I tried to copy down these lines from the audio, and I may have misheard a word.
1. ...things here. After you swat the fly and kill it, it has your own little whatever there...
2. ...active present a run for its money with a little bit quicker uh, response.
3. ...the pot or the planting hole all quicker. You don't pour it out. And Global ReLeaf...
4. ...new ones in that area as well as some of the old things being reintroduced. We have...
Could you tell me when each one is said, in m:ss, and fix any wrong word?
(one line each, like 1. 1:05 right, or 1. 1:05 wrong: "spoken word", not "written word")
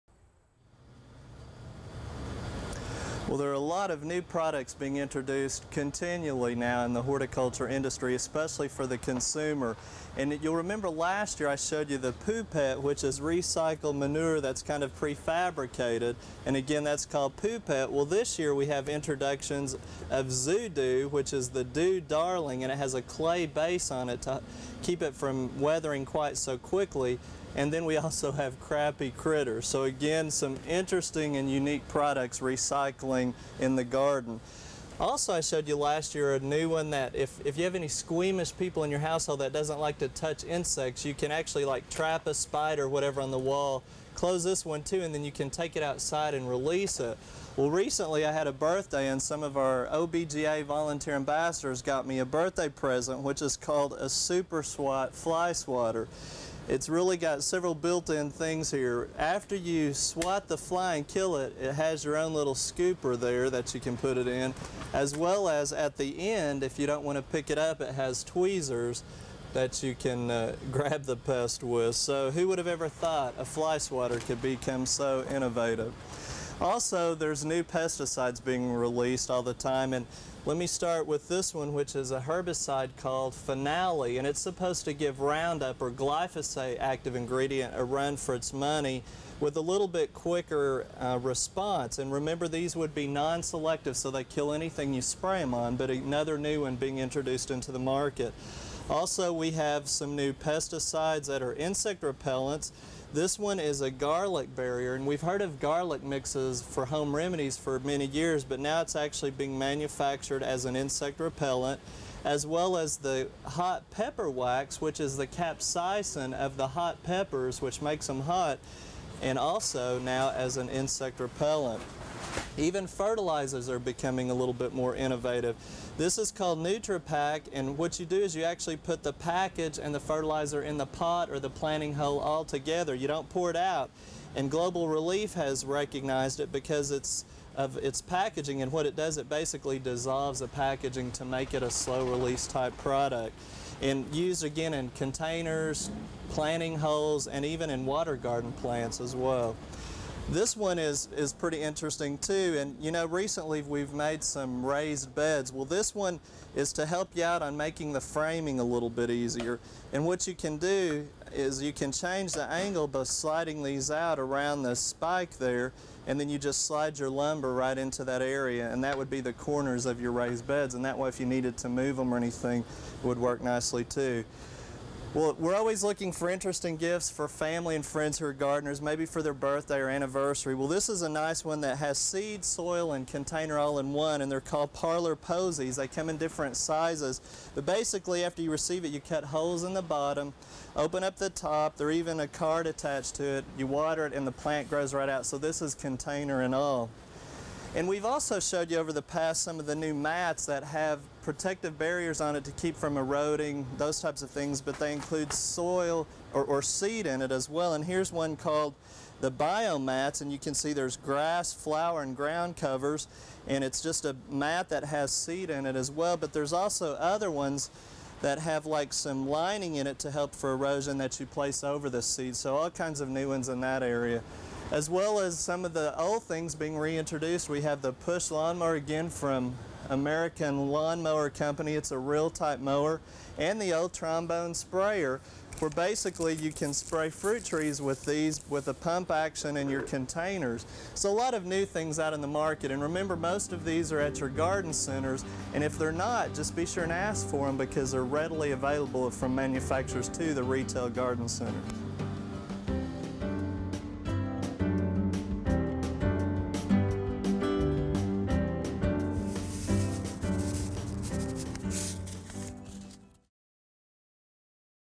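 1. 0:58 wrong: "scooper", not "whatever"
2. 1:26 wrong: "ingredient", not "present"
3. 2:10 wrong: "together", not "quicker"
4. 3:43 right.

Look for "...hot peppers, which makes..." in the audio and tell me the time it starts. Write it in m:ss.
1:56.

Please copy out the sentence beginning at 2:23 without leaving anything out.
And used again in containers, planting holes, and even in water garden plants as well.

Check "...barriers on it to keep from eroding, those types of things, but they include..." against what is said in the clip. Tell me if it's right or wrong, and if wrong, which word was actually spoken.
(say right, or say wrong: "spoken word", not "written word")
right.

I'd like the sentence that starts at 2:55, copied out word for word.
Well, we're always looking for interesting gifts for family and friends who are gardeners, maybe for their birthday or anniversary.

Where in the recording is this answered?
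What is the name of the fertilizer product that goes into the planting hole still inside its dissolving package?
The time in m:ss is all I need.
2:06.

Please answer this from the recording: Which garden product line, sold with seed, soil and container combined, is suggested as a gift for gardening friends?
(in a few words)
parlor posies.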